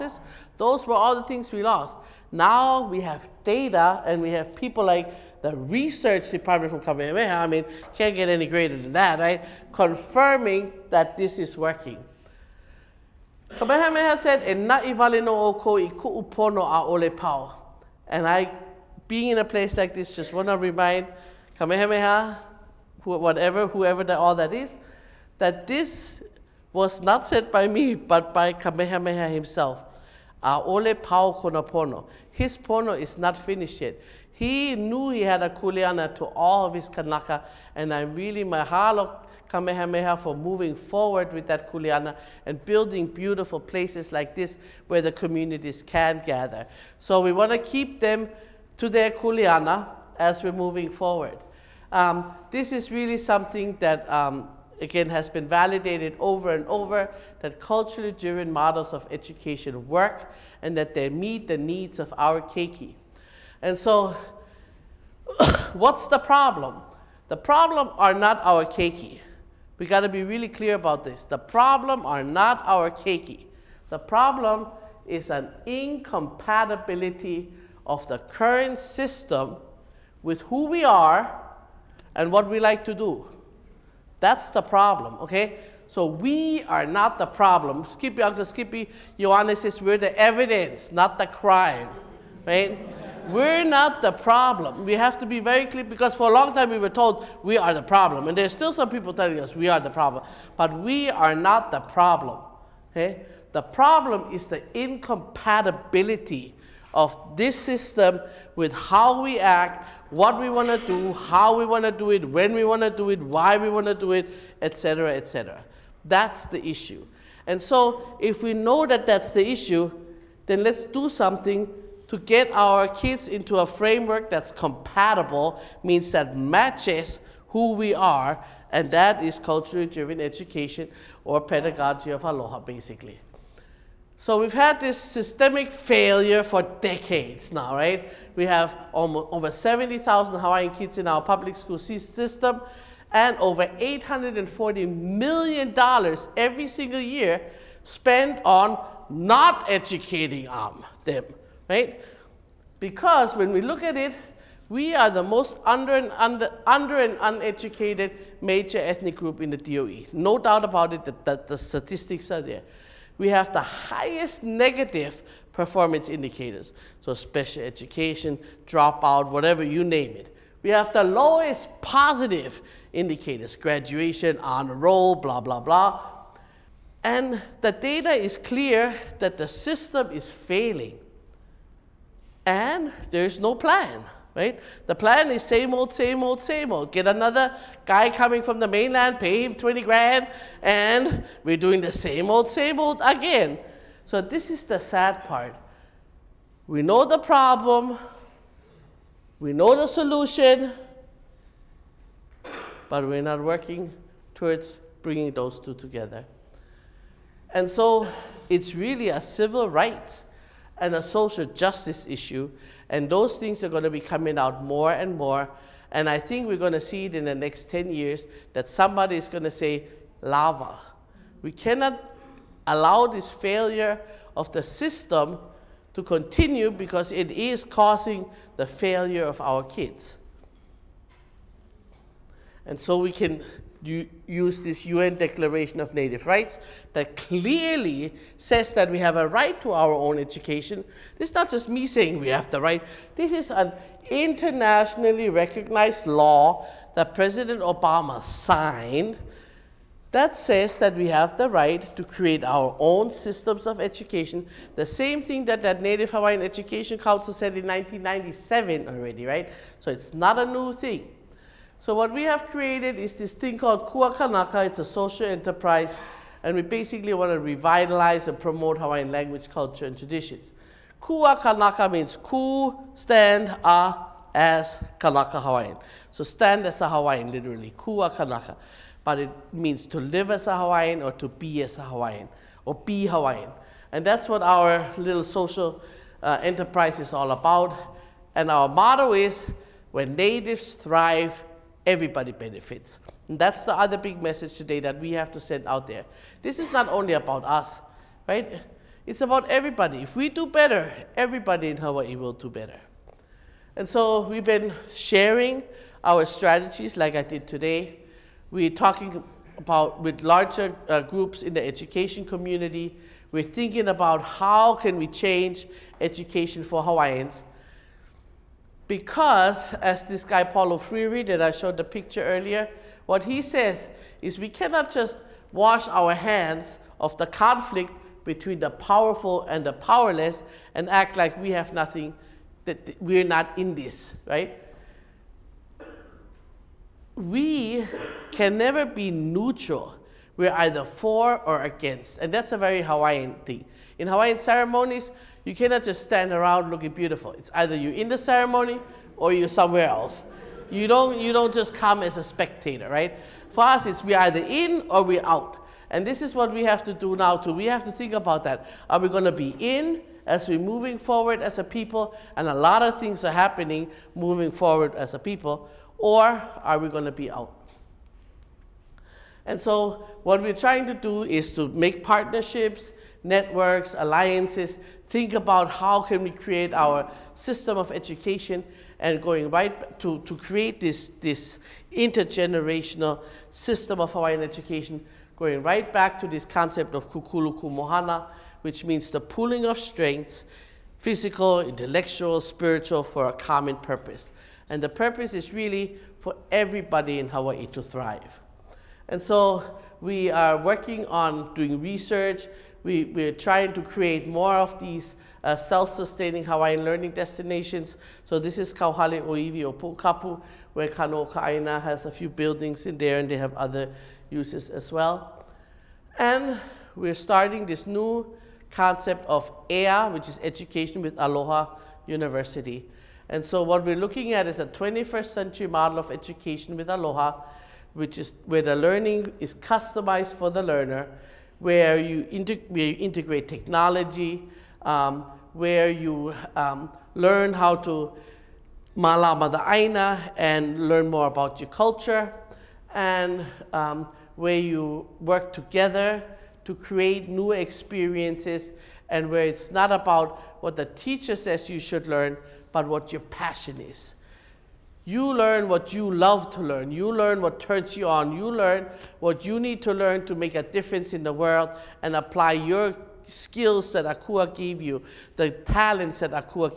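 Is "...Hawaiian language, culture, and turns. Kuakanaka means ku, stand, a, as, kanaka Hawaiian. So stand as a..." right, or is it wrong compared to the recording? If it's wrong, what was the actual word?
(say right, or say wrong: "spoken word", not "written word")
wrong: "traditions", not "turns".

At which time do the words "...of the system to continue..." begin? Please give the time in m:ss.
3:44.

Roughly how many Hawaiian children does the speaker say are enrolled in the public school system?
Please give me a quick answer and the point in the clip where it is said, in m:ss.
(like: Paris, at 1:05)
70,000, at 2:19.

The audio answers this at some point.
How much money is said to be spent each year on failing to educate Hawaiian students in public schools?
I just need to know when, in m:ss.
2:23.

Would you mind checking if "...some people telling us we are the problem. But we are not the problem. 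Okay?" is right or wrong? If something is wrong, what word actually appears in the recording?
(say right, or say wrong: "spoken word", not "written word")
right.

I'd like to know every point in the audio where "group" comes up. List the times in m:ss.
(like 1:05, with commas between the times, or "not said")
2:39, 5:11.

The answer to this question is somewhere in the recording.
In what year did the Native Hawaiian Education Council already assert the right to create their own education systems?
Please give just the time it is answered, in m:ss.
4:17.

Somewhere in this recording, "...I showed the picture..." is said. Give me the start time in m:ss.
5:21.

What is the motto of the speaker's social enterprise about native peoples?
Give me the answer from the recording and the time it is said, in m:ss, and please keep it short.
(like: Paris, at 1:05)
When natives thrive, everybody benefits, at 4:49.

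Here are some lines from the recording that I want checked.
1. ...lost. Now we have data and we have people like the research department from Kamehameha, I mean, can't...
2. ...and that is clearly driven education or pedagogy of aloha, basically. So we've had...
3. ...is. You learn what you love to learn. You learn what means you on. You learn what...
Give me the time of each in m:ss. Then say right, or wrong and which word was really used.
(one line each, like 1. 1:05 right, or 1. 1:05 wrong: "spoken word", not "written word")
1. 0:01 right
2. 2:08 wrong: "culturally", not "clearly"
3. 7:33 wrong: "turns", not "means".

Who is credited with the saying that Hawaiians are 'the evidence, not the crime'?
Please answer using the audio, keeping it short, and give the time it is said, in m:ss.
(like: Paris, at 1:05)
Uncle Skippy Ioane, at 1:27.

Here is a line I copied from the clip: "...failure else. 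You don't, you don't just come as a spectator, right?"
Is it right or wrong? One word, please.
wrong.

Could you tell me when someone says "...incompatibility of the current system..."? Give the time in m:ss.
1:15.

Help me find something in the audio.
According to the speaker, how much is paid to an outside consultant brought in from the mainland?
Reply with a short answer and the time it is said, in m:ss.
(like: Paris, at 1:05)
20 grand, at 3:09.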